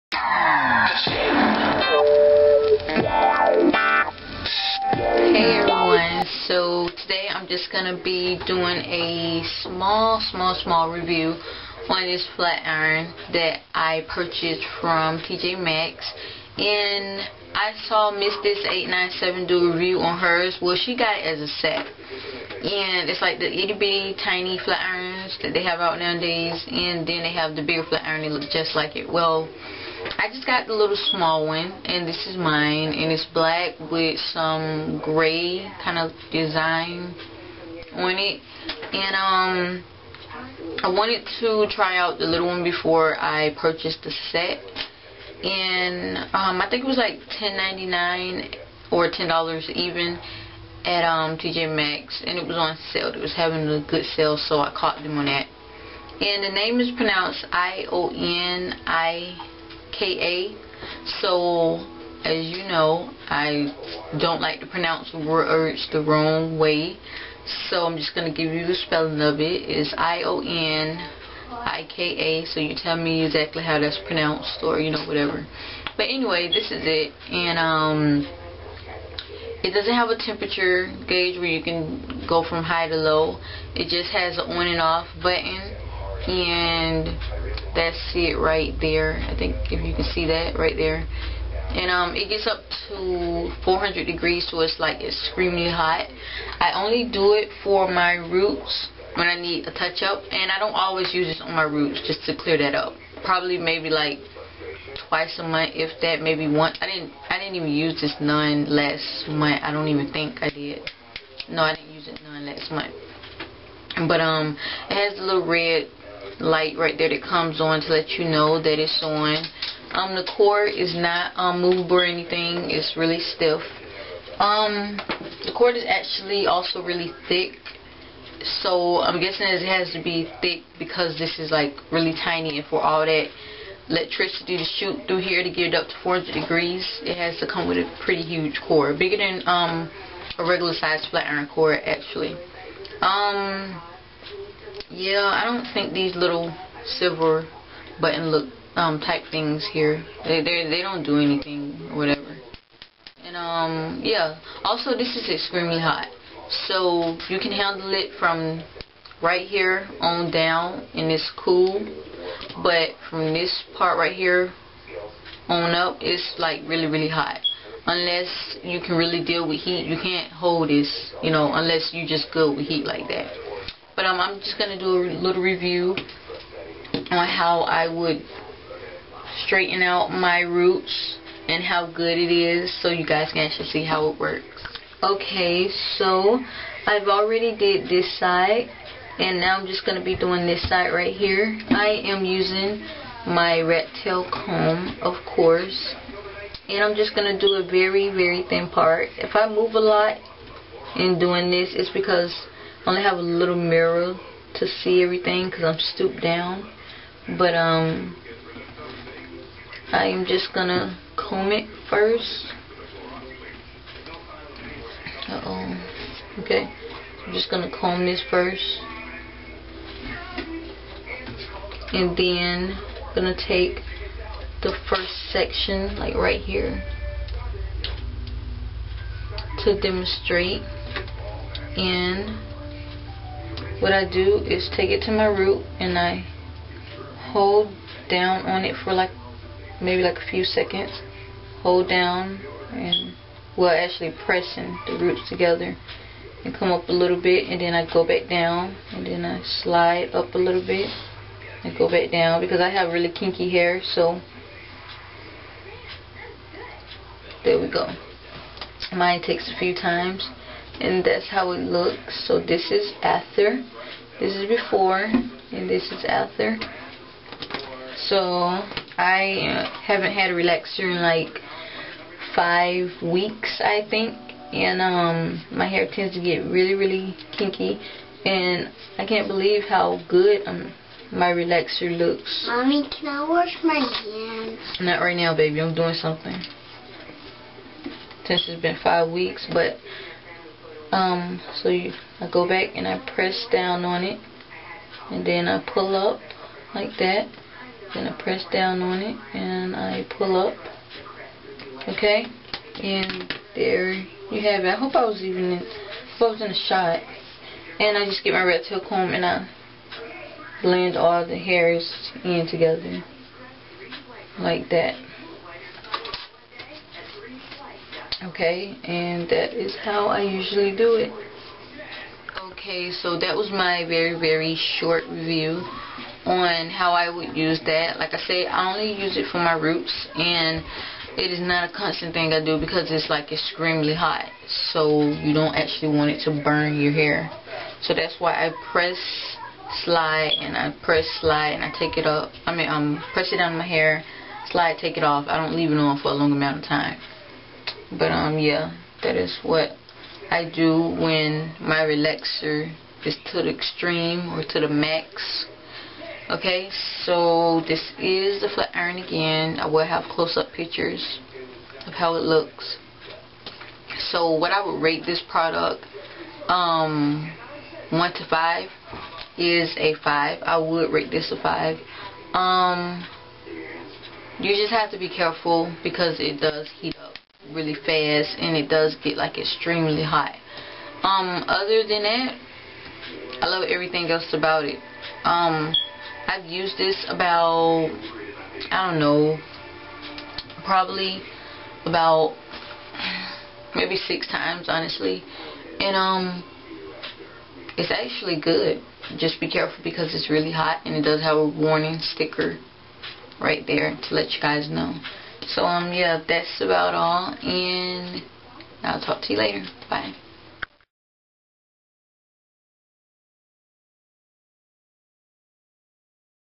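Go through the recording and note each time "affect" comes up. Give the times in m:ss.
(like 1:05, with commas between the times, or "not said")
not said.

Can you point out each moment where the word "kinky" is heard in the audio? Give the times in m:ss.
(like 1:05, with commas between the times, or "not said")
4:13, 4:37.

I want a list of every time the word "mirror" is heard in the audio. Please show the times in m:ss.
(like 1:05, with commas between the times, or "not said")
3:23.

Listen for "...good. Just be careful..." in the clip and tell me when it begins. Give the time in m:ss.
6:38.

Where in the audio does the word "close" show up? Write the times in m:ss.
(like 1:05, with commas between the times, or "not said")
6:00.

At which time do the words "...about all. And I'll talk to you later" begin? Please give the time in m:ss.
6:46.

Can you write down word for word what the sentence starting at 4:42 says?
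Mommy, can I wash my hands?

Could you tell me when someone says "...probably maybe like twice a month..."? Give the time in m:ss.
1:43.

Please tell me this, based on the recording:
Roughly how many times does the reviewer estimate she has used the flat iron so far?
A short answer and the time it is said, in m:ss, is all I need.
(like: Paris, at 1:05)
6 times, at 6:33.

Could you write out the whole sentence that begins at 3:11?
I am using my rat tail comb, of course.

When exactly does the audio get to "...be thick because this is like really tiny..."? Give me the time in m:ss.
2:10.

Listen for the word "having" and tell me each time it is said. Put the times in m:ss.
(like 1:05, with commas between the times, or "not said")
0:53.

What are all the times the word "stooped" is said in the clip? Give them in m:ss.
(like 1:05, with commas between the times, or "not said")
3:25.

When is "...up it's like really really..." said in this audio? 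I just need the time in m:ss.
2:45.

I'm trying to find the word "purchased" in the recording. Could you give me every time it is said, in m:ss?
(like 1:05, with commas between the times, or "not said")
0:14, 0:43.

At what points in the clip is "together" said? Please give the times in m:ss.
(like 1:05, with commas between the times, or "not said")
4:05, 5:12.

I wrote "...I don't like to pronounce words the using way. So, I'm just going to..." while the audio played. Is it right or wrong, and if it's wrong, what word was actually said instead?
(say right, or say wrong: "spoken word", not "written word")
wrong: "wrong", not "using".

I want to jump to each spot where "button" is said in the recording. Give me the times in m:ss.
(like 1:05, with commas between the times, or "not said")
1:25, 2:27.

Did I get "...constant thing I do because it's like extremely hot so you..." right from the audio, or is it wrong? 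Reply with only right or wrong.
right.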